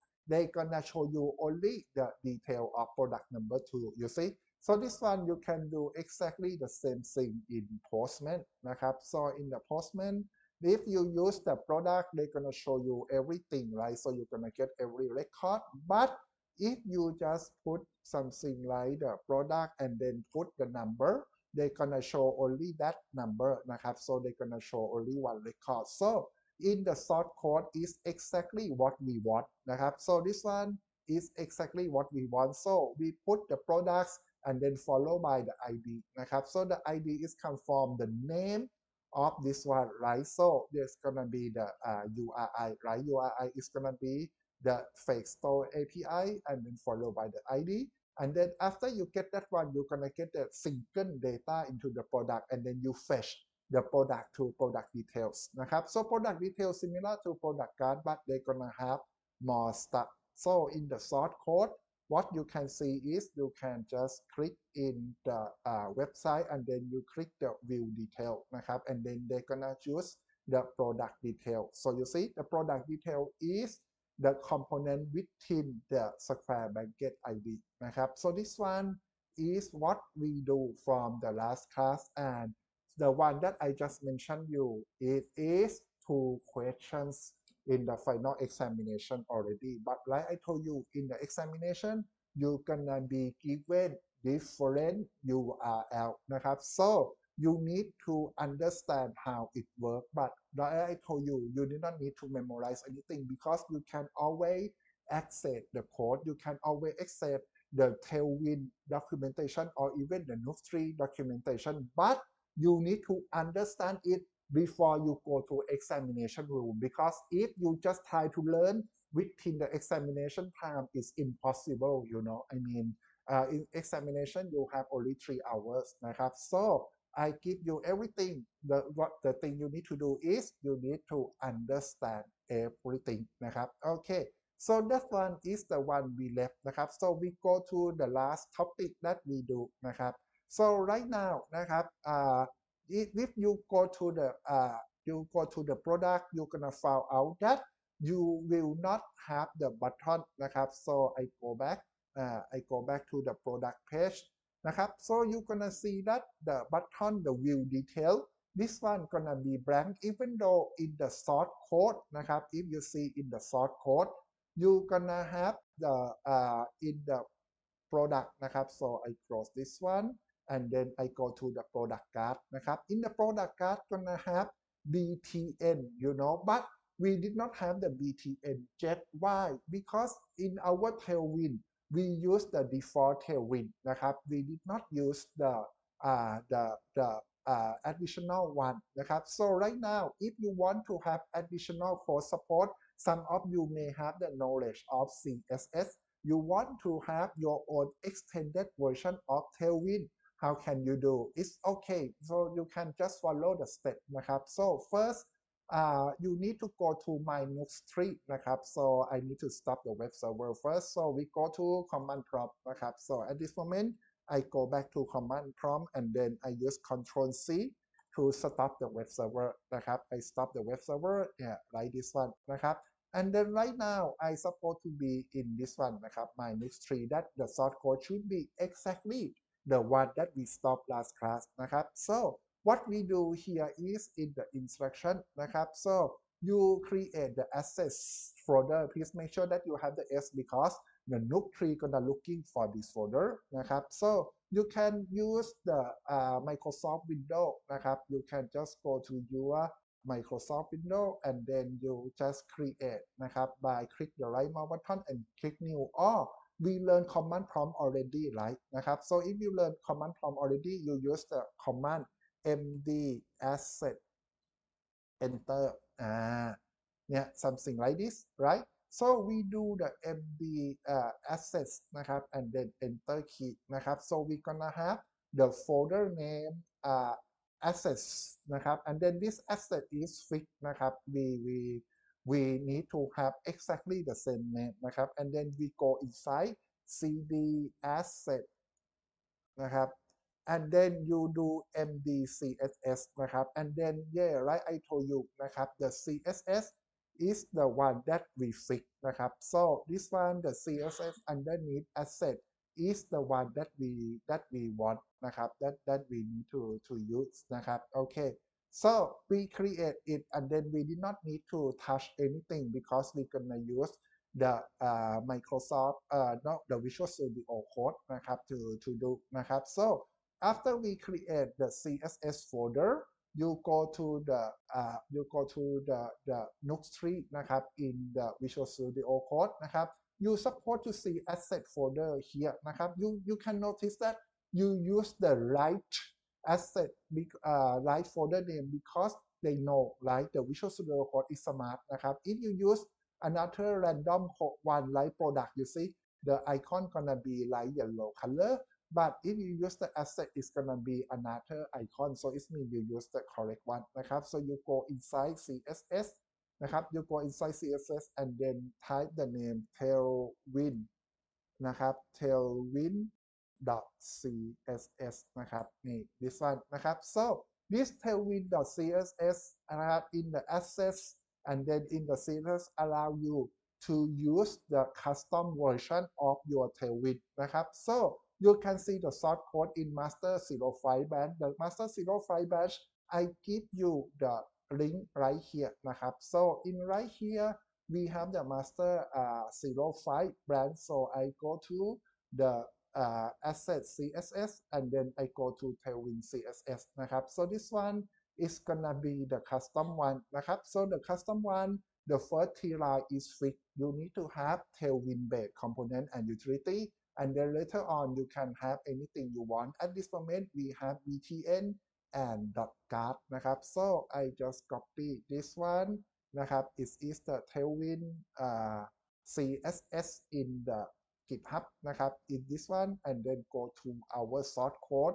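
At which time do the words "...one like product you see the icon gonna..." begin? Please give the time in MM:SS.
05:44.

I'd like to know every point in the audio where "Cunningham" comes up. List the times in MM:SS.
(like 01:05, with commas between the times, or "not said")
not said.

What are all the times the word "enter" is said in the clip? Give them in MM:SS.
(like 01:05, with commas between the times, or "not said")
04:25, 04:32.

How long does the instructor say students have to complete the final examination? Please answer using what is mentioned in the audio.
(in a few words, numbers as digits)
3 hours.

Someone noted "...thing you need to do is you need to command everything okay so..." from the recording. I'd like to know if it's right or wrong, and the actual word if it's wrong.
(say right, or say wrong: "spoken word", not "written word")
wrong: "understand", not "command".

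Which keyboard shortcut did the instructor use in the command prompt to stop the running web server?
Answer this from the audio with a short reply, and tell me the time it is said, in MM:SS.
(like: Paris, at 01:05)
Control C, at 03:36.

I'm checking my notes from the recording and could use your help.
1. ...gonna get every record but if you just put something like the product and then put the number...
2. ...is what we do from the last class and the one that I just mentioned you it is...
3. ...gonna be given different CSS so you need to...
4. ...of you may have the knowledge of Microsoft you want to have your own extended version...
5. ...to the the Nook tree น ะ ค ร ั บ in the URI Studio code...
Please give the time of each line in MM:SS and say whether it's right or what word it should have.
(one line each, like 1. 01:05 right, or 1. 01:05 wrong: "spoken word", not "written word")
1. 00:14 right
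2. 01:19 right
3. 01:32 wrong: "URL", not "CSS"
4. 03:13 wrong: "CSS", not "Microsoft"
5. 05:25 wrong: "Visual", not "URI".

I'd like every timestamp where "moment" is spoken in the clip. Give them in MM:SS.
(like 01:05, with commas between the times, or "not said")
03:33, 06:50.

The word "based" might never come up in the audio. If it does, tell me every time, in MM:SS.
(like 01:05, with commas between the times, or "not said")
06:45.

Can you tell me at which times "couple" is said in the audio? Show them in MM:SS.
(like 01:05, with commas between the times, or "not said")
not said.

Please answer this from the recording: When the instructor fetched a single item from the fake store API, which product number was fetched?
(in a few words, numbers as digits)
2.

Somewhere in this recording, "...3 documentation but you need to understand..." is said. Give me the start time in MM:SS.
01:50.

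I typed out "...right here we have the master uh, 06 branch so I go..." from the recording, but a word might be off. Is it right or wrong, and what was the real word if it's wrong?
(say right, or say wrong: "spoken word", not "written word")
wrong: "05", not "06".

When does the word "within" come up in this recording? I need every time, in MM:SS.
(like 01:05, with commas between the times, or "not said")
01:15, 01:59.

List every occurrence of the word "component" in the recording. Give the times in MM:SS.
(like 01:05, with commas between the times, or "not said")
01:14, 06:45.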